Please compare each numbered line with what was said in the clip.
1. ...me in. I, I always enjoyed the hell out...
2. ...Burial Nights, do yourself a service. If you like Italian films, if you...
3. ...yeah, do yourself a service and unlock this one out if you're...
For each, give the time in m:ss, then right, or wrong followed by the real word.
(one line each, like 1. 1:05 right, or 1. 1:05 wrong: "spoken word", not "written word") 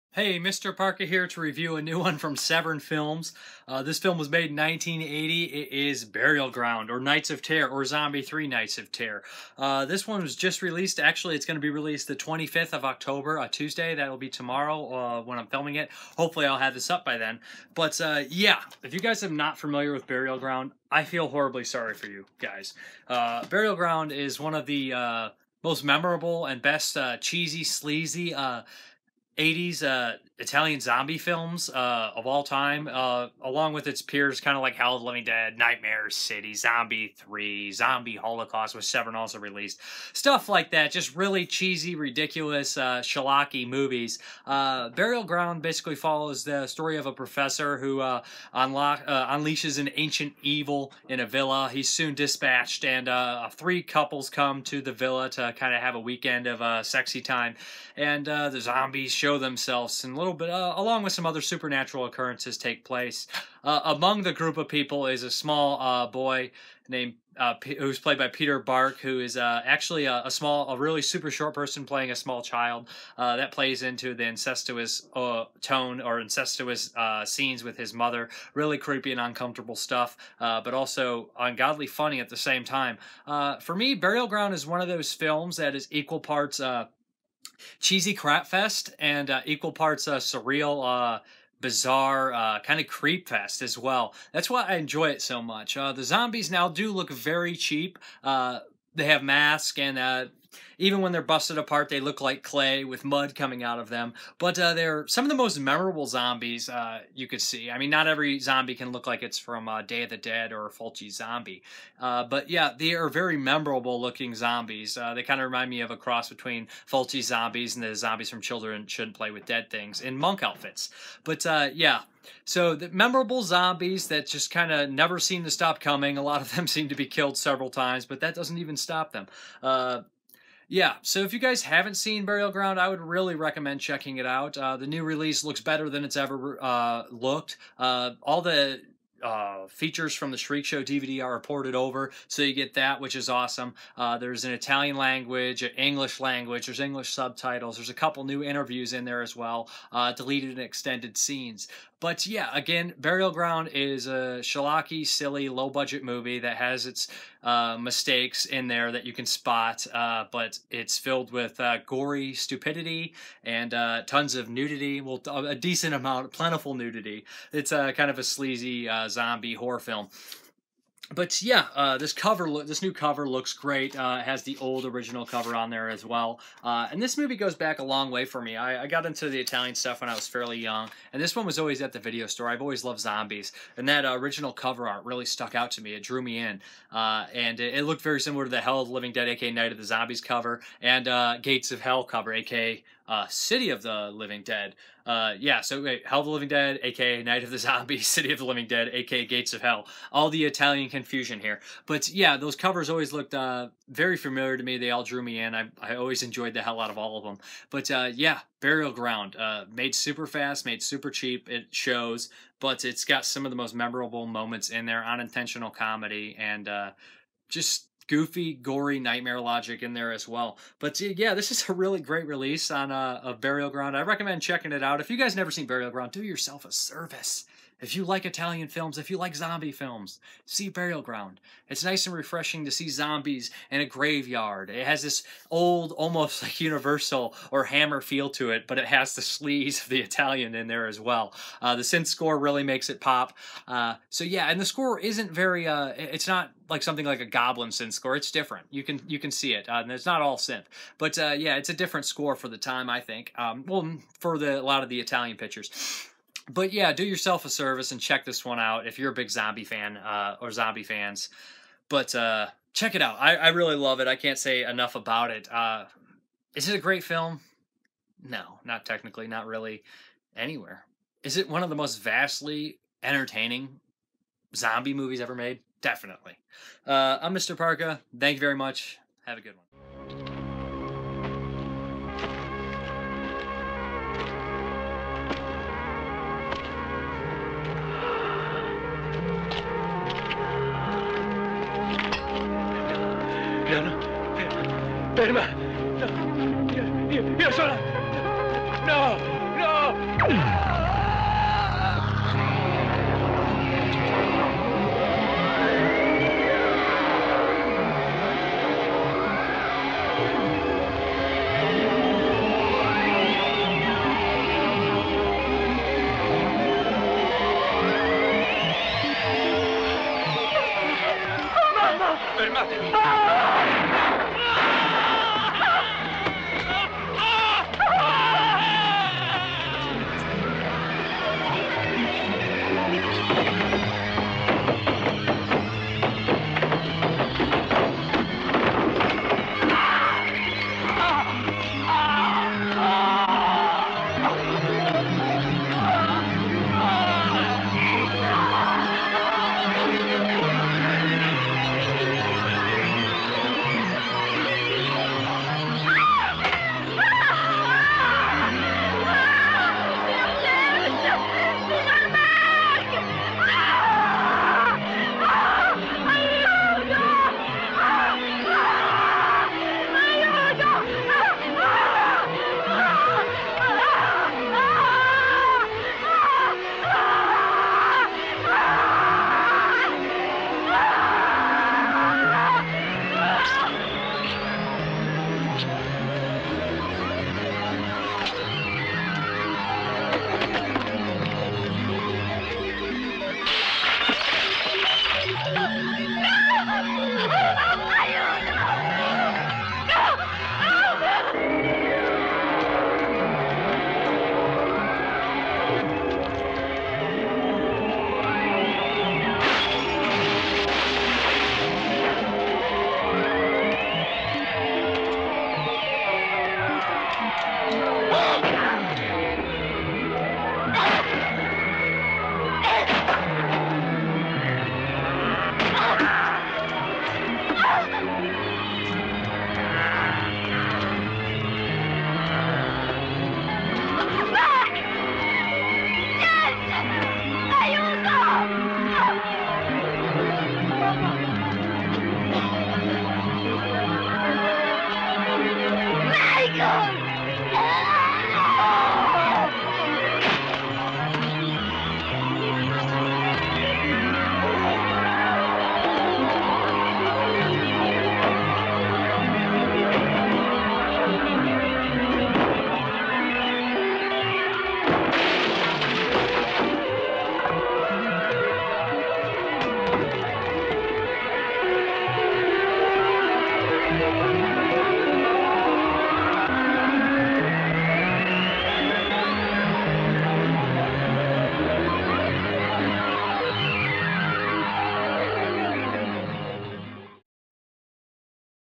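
1. 3:25 right
2. 3:45 wrong: "Ground", not "Nights"
3. 4:16 wrong: "check", not "unlock".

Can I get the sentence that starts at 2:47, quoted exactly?
It's uh, kind of a sleazy zombie horror film.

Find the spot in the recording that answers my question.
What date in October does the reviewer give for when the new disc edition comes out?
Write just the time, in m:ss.
0:12.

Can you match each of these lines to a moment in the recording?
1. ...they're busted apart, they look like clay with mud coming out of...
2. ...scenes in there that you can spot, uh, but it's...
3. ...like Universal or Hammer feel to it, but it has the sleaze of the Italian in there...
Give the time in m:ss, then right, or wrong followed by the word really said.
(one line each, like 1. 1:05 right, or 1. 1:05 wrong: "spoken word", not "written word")
1. 1:41 right
2. 2:37 wrong: "mistakes", not "scenes"
3. 3:56 right.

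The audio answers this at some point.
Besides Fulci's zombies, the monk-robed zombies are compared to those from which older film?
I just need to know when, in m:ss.
1:58.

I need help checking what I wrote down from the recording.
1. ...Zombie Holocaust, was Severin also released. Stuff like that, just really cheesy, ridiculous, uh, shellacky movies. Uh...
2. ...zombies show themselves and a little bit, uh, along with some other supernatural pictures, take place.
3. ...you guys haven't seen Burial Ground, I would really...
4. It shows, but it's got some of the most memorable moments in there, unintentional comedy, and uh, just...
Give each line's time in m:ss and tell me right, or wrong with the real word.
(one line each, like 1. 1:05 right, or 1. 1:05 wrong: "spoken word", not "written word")
1. 0:37 right
2. 0:58 wrong: "occurrences", not "pictures"
3. 2:11 right
4. 3:31 right.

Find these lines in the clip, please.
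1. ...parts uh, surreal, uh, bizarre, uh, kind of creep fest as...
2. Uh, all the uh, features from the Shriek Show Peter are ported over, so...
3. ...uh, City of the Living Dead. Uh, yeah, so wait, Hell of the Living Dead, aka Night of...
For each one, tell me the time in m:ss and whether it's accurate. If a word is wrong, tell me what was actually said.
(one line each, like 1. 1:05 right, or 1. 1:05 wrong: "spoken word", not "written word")
1. 1:29 right
2. 2:17 wrong: "DVD", not "Peter"
3. 3:13 right.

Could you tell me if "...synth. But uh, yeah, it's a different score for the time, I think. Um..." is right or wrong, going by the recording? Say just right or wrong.
right.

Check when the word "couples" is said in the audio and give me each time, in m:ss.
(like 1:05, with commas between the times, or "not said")
0:53, 2:27.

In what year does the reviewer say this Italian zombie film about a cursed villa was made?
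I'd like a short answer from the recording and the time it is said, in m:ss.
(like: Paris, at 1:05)
1980, at 0:04.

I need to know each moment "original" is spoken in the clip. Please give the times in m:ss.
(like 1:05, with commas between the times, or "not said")
2:54, 3:04.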